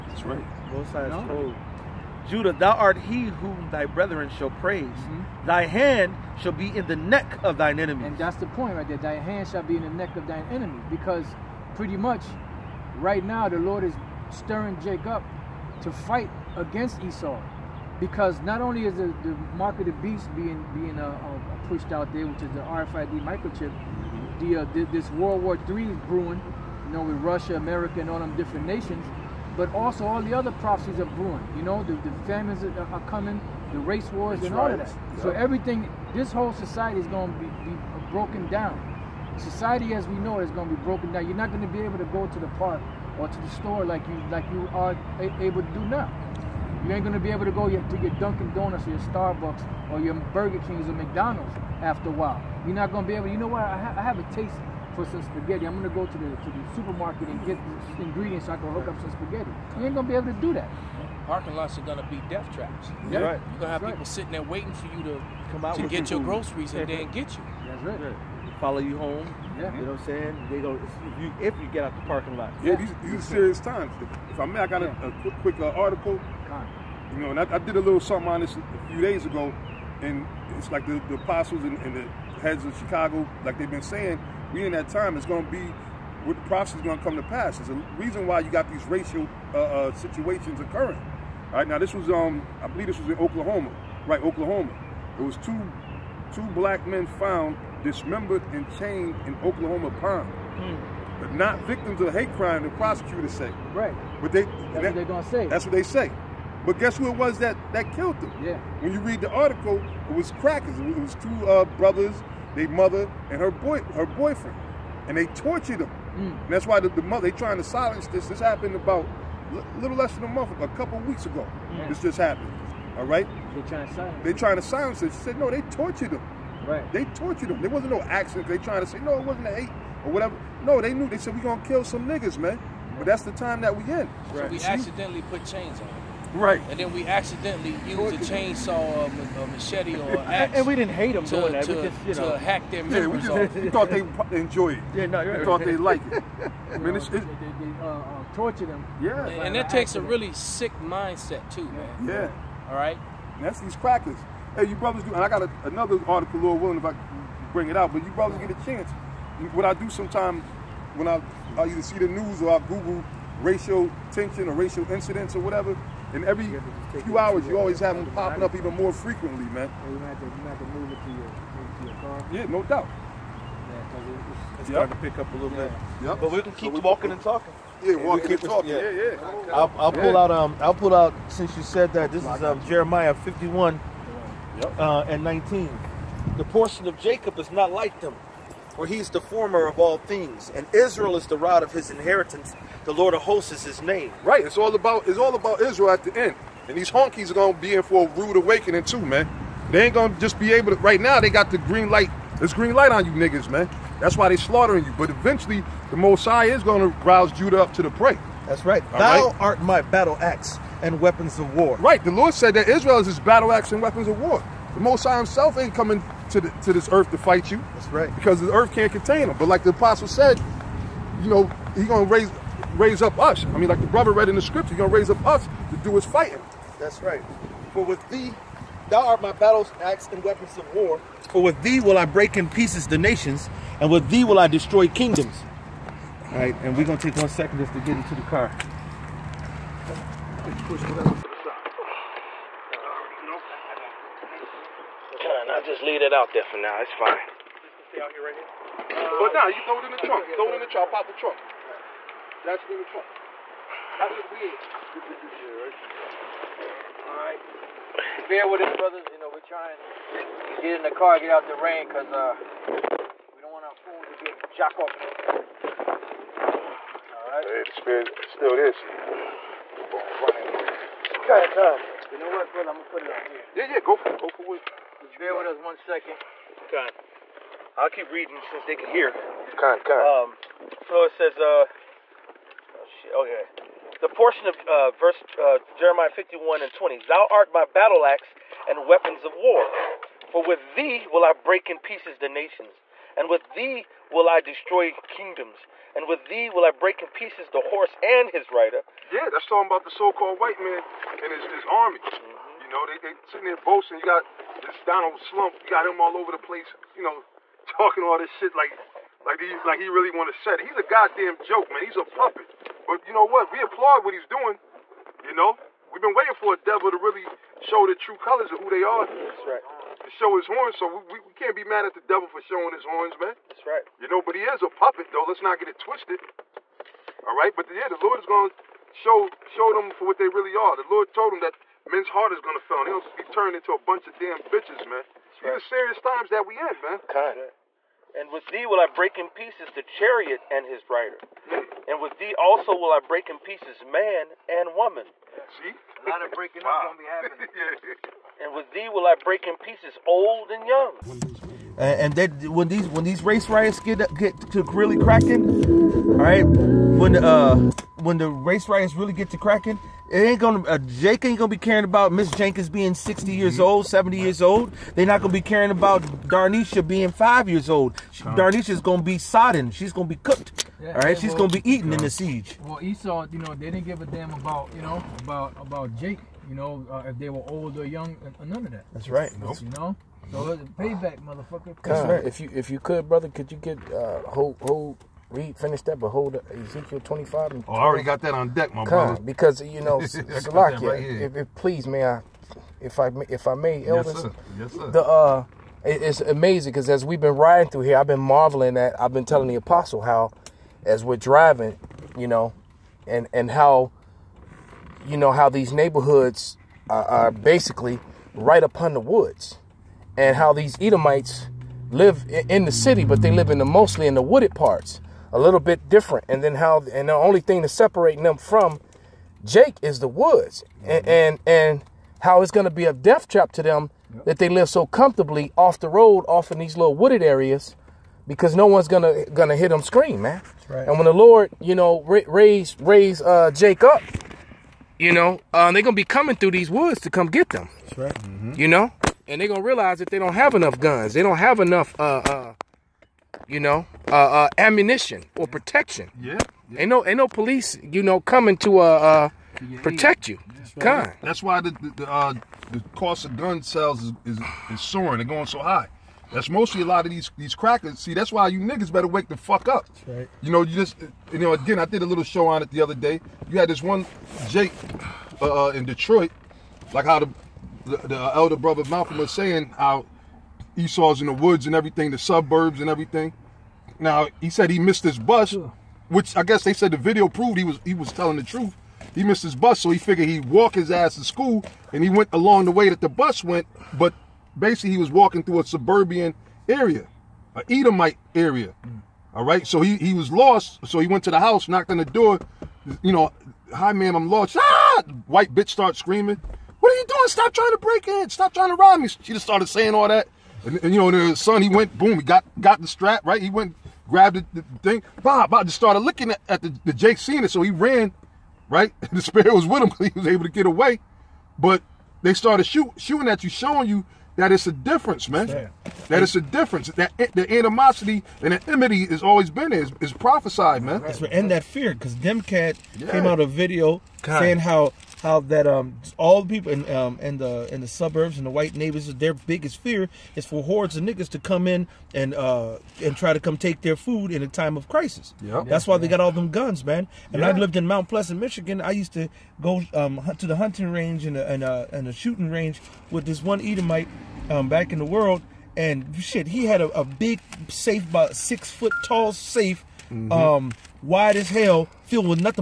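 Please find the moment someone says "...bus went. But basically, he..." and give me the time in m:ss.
8:03.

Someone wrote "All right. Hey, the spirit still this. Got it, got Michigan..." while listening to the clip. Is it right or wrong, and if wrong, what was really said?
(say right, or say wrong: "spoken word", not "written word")
wrong: "You", not "Michigan".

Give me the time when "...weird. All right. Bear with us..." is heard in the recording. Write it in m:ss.
4:14.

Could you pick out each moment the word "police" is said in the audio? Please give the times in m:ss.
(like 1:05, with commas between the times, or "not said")
7:27.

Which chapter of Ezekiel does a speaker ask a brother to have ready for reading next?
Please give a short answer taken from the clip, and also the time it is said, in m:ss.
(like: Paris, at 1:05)
Ezekiel 25, at 6:26.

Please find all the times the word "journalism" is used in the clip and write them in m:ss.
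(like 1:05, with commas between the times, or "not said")
not said.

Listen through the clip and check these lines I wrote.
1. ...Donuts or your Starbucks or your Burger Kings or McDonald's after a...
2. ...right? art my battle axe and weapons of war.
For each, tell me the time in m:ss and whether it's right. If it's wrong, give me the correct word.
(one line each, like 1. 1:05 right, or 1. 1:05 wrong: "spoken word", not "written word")
1. 0:48 right
2. 3:29 right.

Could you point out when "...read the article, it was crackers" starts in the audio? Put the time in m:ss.
1:48.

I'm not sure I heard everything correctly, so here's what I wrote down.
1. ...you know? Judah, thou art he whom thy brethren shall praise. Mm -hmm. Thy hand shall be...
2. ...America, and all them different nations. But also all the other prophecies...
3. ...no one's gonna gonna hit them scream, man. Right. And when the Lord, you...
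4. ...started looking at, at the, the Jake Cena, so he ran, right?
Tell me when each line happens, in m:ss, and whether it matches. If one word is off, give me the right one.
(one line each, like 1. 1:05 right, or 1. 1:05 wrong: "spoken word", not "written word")
1. 0:01 right
2. 0:27 right
3. 7:08 right
4. 8:25 right.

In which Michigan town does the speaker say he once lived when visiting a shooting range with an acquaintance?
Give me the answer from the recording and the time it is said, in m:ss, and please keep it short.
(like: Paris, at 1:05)
Mount Pleasant, at 8:57.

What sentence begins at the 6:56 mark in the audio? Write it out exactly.
And then how and the only thing that's separating them from Jake is the woods mm -hmm.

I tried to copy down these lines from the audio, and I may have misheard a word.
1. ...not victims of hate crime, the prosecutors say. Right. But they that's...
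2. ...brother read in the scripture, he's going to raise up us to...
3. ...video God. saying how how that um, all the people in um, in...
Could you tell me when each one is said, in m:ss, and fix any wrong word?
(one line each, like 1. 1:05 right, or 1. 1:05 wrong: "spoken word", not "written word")
1. 1:41 right
2. 3:43 right
3. 8:43 right.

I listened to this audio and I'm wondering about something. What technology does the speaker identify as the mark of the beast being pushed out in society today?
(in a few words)
RFID microchip.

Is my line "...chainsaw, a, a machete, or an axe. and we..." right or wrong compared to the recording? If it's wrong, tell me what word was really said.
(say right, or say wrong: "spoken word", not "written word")
right.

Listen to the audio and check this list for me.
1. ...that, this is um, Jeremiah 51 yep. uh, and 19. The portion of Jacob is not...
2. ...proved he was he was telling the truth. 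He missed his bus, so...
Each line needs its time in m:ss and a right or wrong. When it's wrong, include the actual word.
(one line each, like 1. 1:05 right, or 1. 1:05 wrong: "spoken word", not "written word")
1. 3:01 right
2. 7:57 right.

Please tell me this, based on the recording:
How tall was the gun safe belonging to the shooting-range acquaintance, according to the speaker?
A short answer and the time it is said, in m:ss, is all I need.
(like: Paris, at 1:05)
6 feet, at 9:08.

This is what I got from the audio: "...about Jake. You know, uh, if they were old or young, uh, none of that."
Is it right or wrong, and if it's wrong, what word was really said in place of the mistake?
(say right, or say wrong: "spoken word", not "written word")
right.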